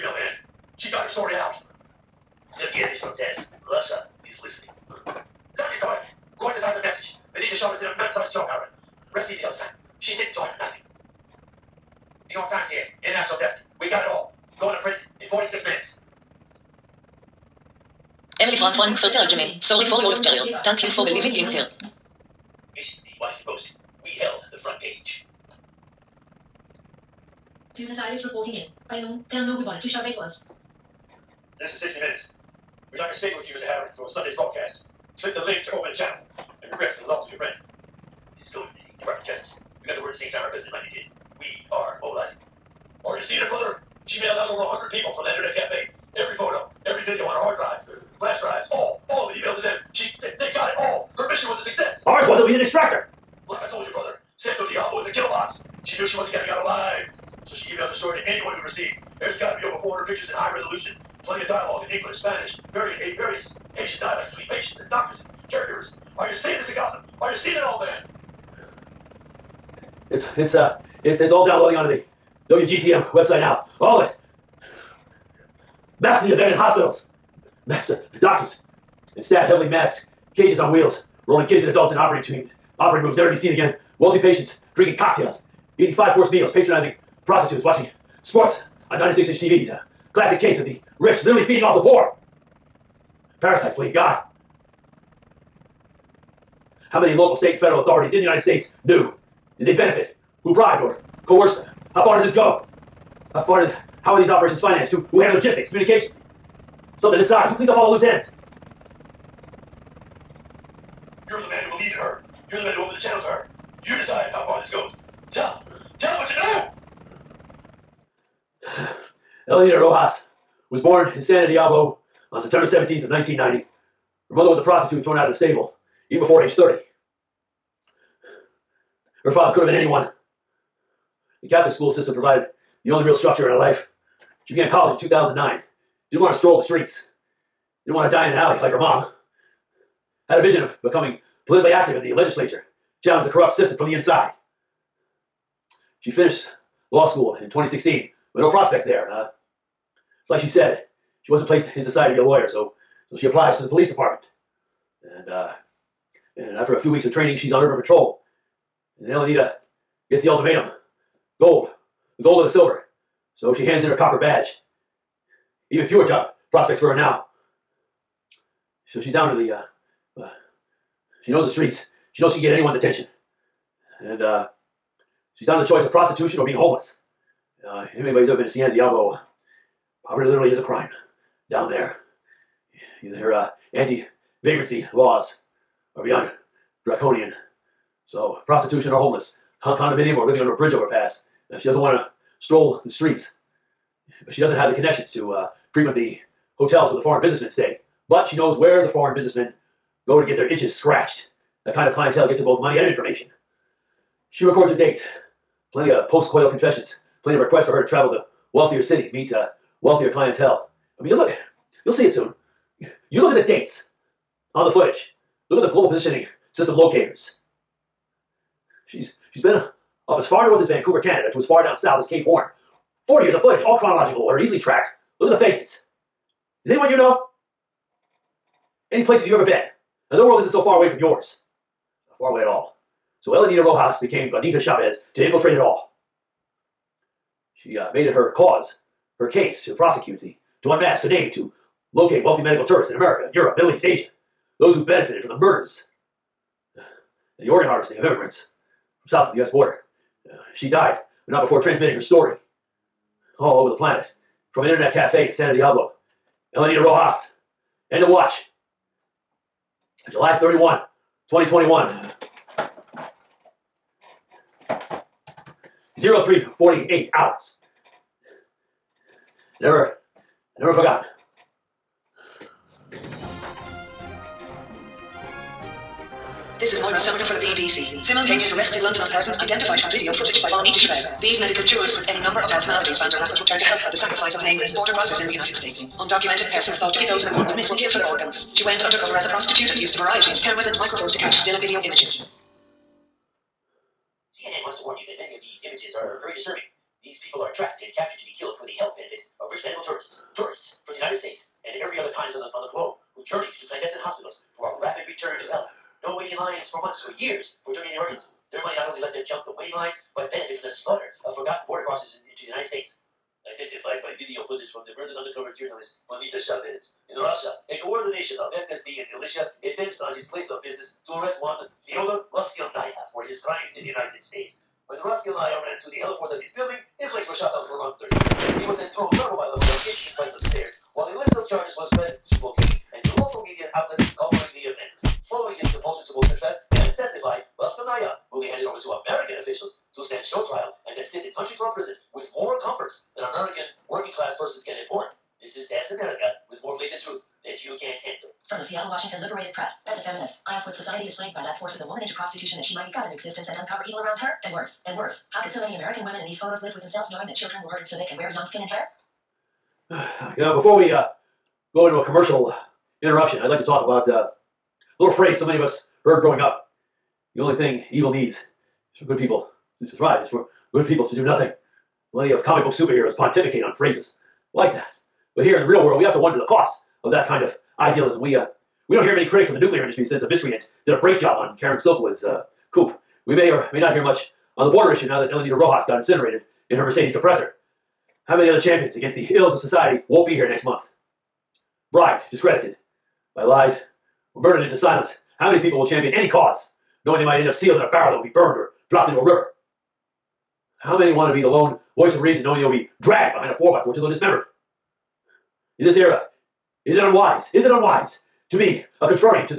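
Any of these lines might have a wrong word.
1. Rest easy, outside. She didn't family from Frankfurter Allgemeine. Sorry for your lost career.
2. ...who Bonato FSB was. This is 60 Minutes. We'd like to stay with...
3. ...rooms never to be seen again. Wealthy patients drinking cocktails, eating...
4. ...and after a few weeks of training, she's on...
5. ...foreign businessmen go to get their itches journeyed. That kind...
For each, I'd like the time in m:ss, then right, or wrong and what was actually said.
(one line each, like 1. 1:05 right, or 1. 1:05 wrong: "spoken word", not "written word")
1. 0:09 right
2. 0:29 wrong: "Chavez", not "FSB"
3. 1:23 right
4. 2:36 right
5. 3:18 wrong: "scratched", not "journeyed".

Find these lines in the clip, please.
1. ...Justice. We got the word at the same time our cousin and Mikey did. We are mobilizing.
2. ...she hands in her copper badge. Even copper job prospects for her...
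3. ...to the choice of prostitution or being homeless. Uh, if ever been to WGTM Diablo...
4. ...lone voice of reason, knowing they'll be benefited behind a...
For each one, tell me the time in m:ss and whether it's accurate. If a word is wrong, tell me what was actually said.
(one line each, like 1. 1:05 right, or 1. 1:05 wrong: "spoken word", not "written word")
1. 0:39 right
2. 2:43 wrong: "fewer", not "copper"
3. 2:55 wrong: "Ciudad", not "WGTM"
4. 6:41 wrong: "dragged", not "benefited".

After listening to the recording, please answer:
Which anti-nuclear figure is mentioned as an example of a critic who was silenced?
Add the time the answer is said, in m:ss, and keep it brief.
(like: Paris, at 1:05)
Karen Silkwood, at 6:21.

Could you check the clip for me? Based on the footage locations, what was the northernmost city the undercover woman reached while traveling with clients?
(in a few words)
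Vancouver.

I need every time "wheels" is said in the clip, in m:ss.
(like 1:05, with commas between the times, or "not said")
1:20.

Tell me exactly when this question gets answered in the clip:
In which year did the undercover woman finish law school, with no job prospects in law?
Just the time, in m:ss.
2:27.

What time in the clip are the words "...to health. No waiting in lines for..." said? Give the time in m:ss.
5:05.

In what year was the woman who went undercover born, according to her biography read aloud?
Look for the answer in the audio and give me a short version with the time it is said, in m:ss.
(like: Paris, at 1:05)
1990, at 2:03.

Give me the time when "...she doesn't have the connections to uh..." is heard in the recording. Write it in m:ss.
3:14.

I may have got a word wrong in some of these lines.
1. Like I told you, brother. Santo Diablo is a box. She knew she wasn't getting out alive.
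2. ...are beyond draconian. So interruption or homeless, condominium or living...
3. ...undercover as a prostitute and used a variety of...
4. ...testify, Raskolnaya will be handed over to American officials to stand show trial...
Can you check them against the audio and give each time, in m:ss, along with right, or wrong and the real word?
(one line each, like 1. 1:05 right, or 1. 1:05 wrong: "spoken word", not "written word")
1. 0:53 right
2. 3:05 wrong: "prostitution", not "interruption"
3. 4:48 right
4. 5:36 right.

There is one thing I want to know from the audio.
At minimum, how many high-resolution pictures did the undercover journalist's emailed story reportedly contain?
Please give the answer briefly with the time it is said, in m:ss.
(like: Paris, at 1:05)
400, at 0:59.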